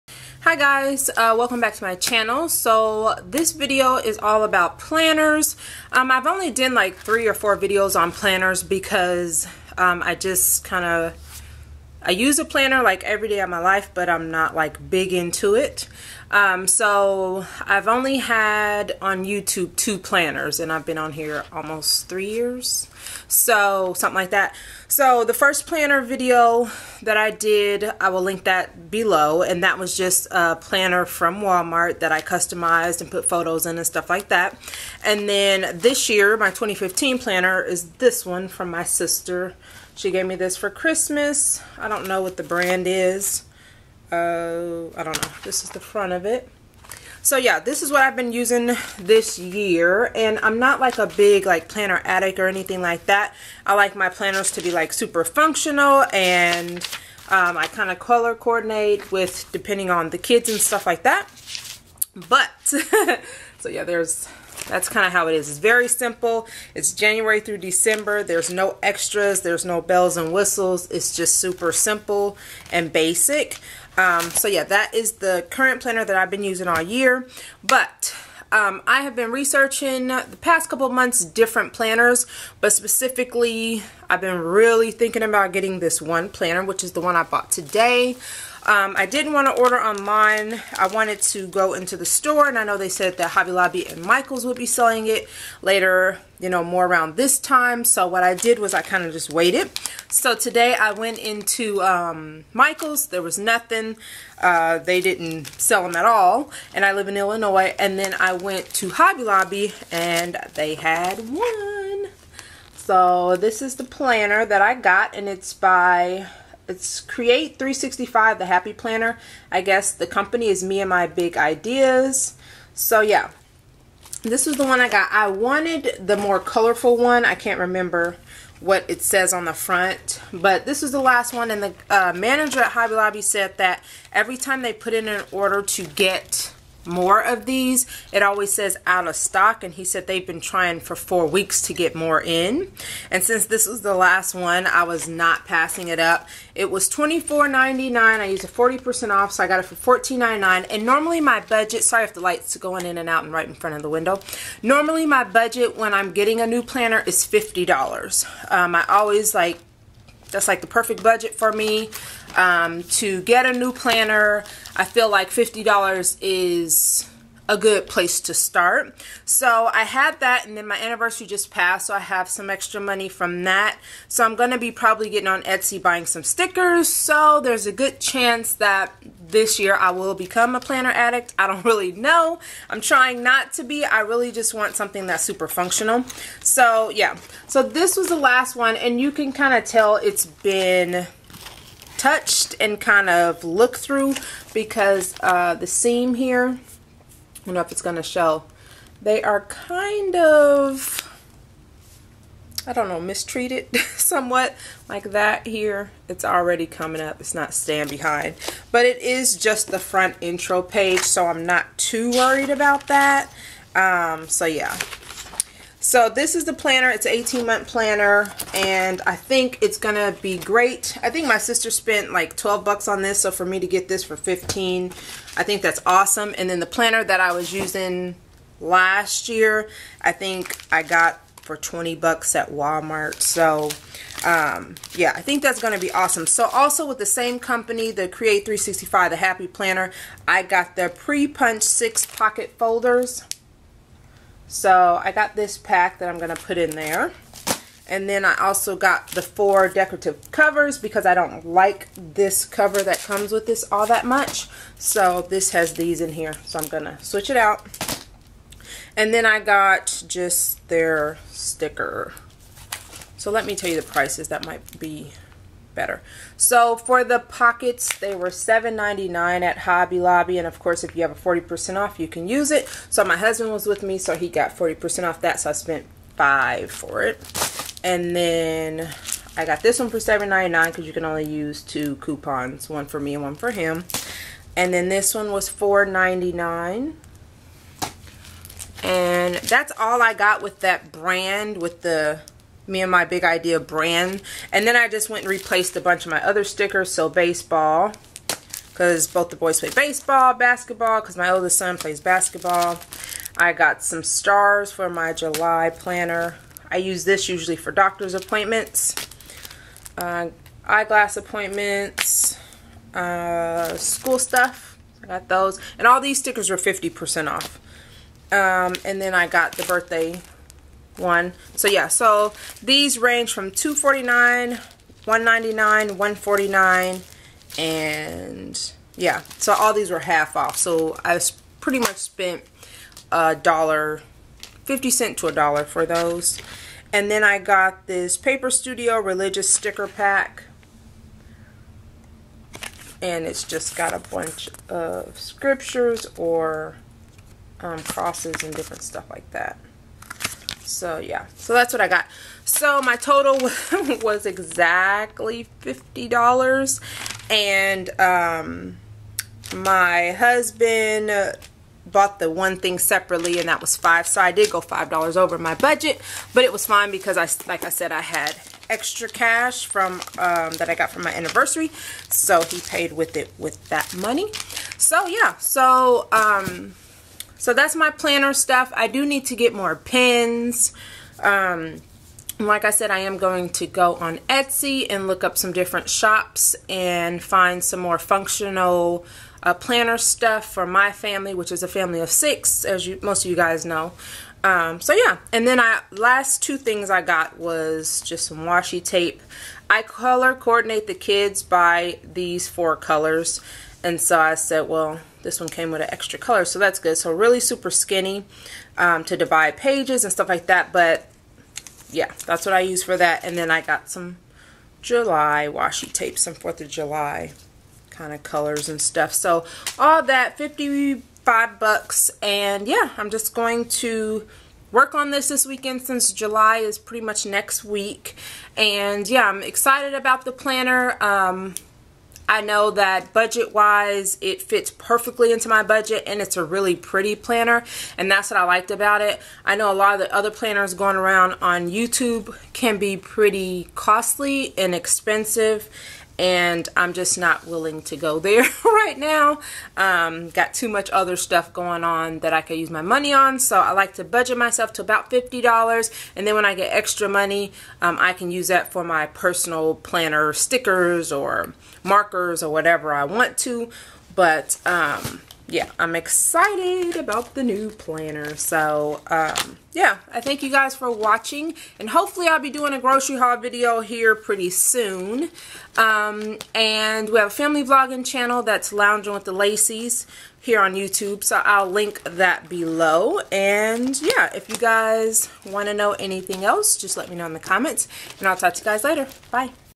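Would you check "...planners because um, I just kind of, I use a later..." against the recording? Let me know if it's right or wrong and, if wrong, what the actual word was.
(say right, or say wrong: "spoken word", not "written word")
wrong: "planner", not "later".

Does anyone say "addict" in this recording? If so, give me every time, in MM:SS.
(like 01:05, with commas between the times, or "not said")
00:52, 03:00.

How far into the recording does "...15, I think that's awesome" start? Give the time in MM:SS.
03:44.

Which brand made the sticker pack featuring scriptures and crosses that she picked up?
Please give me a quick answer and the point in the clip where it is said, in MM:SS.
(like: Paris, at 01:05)
Paper Studio, at 05:38.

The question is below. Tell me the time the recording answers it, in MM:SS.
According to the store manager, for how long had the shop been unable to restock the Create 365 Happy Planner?
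02:20.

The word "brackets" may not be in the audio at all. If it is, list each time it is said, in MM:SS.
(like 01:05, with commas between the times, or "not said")
not said.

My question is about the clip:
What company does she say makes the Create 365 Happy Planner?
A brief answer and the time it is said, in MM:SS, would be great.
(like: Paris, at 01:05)
Me and My Big Ideas, at 02:00.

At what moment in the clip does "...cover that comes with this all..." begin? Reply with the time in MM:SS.
04:12.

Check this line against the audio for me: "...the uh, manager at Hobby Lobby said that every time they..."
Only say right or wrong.
right.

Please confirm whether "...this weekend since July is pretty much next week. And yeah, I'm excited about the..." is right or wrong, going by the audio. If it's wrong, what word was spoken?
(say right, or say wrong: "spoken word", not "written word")
right.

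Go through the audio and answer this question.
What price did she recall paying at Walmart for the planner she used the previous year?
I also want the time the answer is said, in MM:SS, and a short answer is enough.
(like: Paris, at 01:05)
$20, at 03:49.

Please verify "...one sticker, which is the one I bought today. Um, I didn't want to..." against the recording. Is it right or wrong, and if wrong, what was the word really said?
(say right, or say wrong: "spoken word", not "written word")
wrong: "planner", not "sticker".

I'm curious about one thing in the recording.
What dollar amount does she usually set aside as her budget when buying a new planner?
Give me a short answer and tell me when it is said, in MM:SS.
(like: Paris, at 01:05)
$50, at 02:34.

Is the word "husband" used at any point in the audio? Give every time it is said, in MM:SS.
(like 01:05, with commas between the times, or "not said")
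04:33, 06:00.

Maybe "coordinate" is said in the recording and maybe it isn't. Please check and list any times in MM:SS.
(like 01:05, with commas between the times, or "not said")
00:58, 06:40.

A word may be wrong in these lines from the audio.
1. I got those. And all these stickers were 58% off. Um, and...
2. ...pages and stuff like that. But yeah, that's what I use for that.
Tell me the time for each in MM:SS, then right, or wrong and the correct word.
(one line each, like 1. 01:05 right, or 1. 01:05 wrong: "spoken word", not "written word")
1. 05:15 wrong: "50", not "58"
2. 06:49 right.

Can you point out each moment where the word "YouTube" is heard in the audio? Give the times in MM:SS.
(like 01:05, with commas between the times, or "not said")
00:19, 07:21, 08:00.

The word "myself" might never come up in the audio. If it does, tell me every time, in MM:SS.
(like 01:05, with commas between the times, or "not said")
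07:34.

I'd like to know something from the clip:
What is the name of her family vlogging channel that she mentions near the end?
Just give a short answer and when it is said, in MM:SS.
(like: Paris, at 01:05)
Lounging with the Lacy's, at 07:58.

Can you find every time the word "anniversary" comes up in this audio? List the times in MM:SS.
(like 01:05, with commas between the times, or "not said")
02:50, 06:11.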